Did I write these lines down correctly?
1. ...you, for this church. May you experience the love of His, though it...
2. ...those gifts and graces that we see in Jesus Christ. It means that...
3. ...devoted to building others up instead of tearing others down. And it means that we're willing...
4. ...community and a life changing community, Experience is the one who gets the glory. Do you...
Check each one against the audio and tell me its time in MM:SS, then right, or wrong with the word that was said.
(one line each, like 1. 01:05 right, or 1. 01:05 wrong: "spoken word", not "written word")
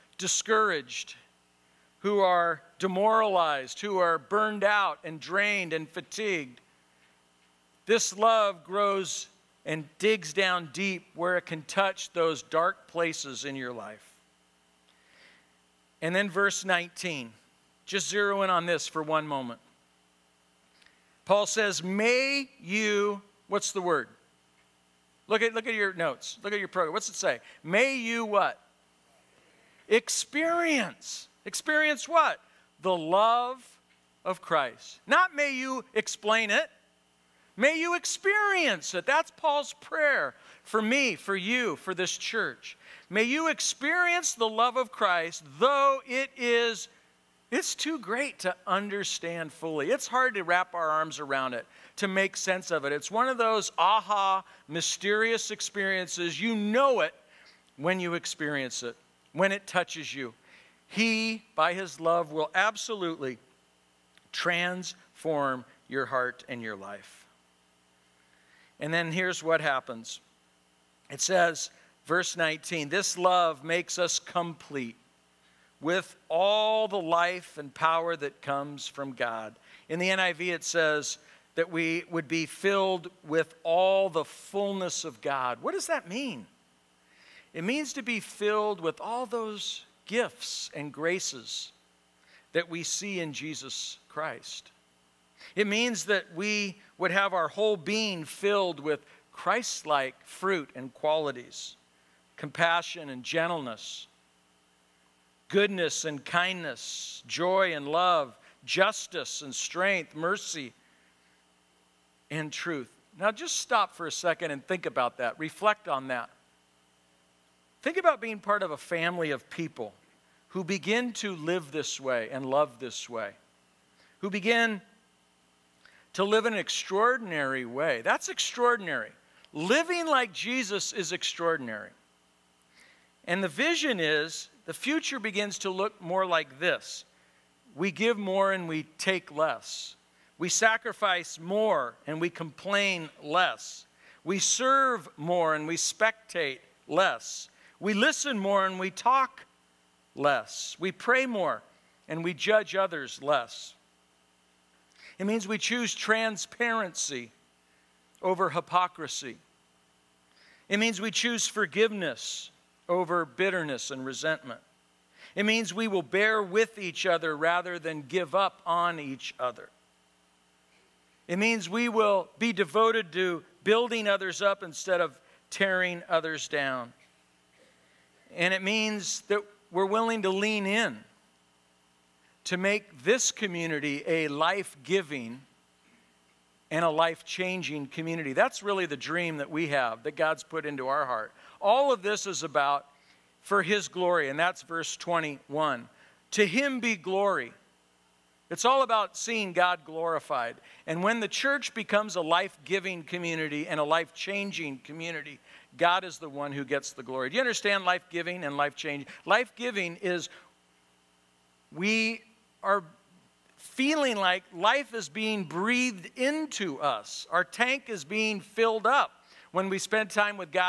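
1. 00:41 wrong: "Christ", not "His"
2. 01:29 right
3. 02:52 right
4. 03:23 wrong: "God", not "Experience".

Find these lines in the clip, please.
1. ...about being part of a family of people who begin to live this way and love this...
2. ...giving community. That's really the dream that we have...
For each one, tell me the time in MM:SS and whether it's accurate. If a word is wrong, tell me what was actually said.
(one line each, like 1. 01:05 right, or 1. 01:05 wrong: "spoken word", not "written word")
1. 01:57 right
2. 03:07 wrong: "changing", not "giving".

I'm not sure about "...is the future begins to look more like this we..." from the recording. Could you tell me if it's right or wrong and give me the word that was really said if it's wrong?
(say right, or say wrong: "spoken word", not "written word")
right.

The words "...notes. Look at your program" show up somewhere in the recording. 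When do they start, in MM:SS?
00:25.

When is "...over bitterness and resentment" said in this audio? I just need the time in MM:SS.
02:42.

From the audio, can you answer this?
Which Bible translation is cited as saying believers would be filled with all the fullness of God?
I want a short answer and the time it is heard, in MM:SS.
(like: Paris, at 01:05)
NIV, at 01:20.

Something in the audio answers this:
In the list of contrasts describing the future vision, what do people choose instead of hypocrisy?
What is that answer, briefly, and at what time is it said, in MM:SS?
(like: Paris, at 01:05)
Transparency, at 02:35.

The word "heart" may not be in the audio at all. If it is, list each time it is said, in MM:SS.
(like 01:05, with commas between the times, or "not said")
01:06, 03:11.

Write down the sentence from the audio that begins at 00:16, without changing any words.
And then verse 19, just zero in on this for one moment.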